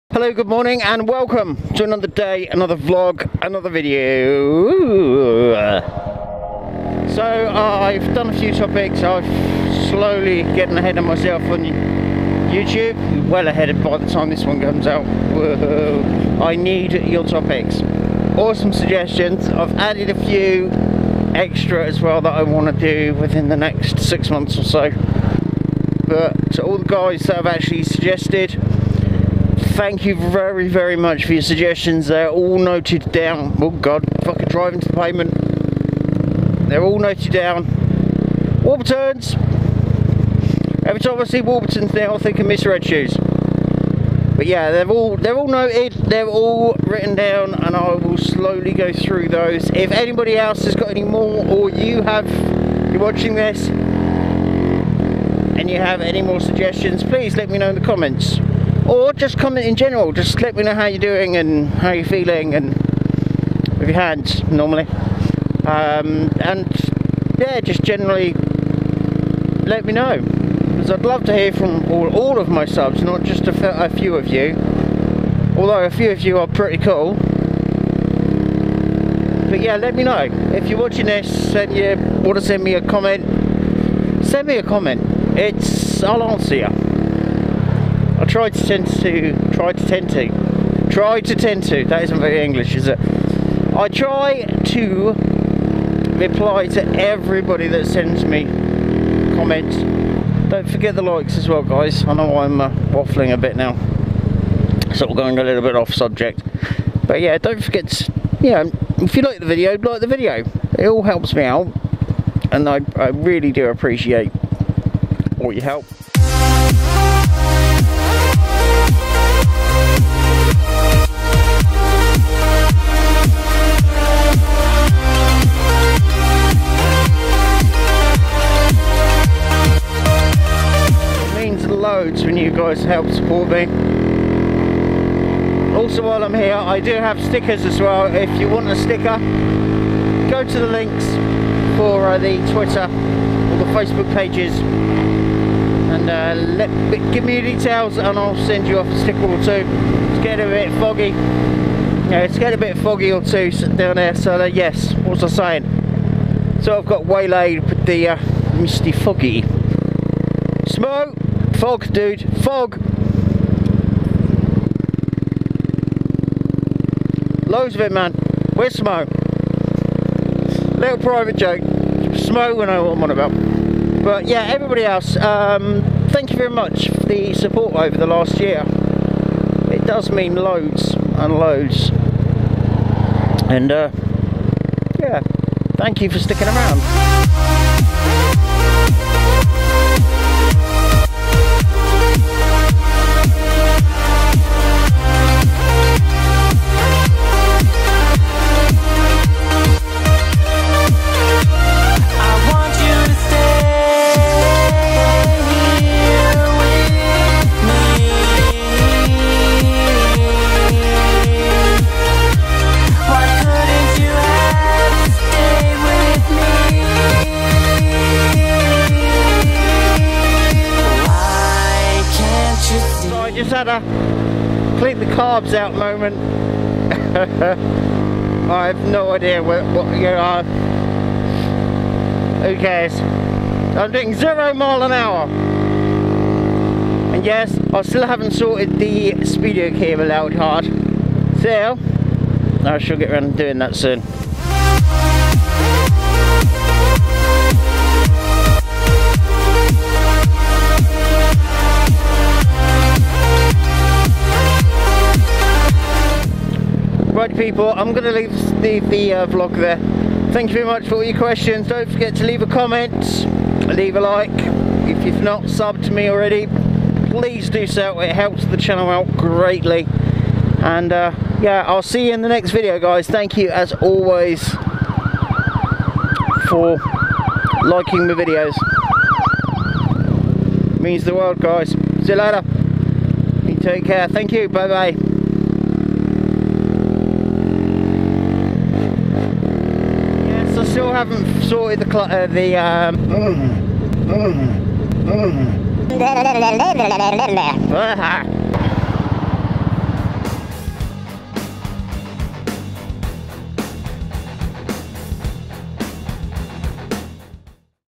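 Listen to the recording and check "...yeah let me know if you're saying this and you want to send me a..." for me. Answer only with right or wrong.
wrong.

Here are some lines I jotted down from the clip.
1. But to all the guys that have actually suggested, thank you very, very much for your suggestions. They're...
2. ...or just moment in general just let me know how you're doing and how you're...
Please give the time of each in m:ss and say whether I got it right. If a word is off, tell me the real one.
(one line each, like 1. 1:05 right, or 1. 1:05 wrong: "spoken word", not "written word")
1. 0:26 right
2. 0:58 wrong: "comment", not "moment".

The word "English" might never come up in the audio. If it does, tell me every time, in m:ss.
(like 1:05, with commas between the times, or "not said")
1:32.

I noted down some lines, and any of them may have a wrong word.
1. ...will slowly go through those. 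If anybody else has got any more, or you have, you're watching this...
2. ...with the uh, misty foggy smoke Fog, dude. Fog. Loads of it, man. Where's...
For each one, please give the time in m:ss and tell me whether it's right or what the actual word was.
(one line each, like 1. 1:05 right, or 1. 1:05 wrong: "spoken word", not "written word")
1. 0:47 right
2. 2:37 right.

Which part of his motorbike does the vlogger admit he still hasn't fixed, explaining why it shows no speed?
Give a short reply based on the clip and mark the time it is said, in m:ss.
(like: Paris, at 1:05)
speedo cable, at 3:59.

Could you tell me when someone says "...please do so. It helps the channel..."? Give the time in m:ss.
4:27.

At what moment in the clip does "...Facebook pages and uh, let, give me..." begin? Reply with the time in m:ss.
2:23.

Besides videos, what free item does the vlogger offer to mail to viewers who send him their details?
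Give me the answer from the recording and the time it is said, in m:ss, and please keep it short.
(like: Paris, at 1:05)
stickers, at 2:17.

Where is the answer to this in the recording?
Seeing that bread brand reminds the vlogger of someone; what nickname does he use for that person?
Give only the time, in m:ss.
0:42.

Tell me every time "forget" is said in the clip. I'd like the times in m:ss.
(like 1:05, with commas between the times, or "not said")
1:40, 1:47, 4:21.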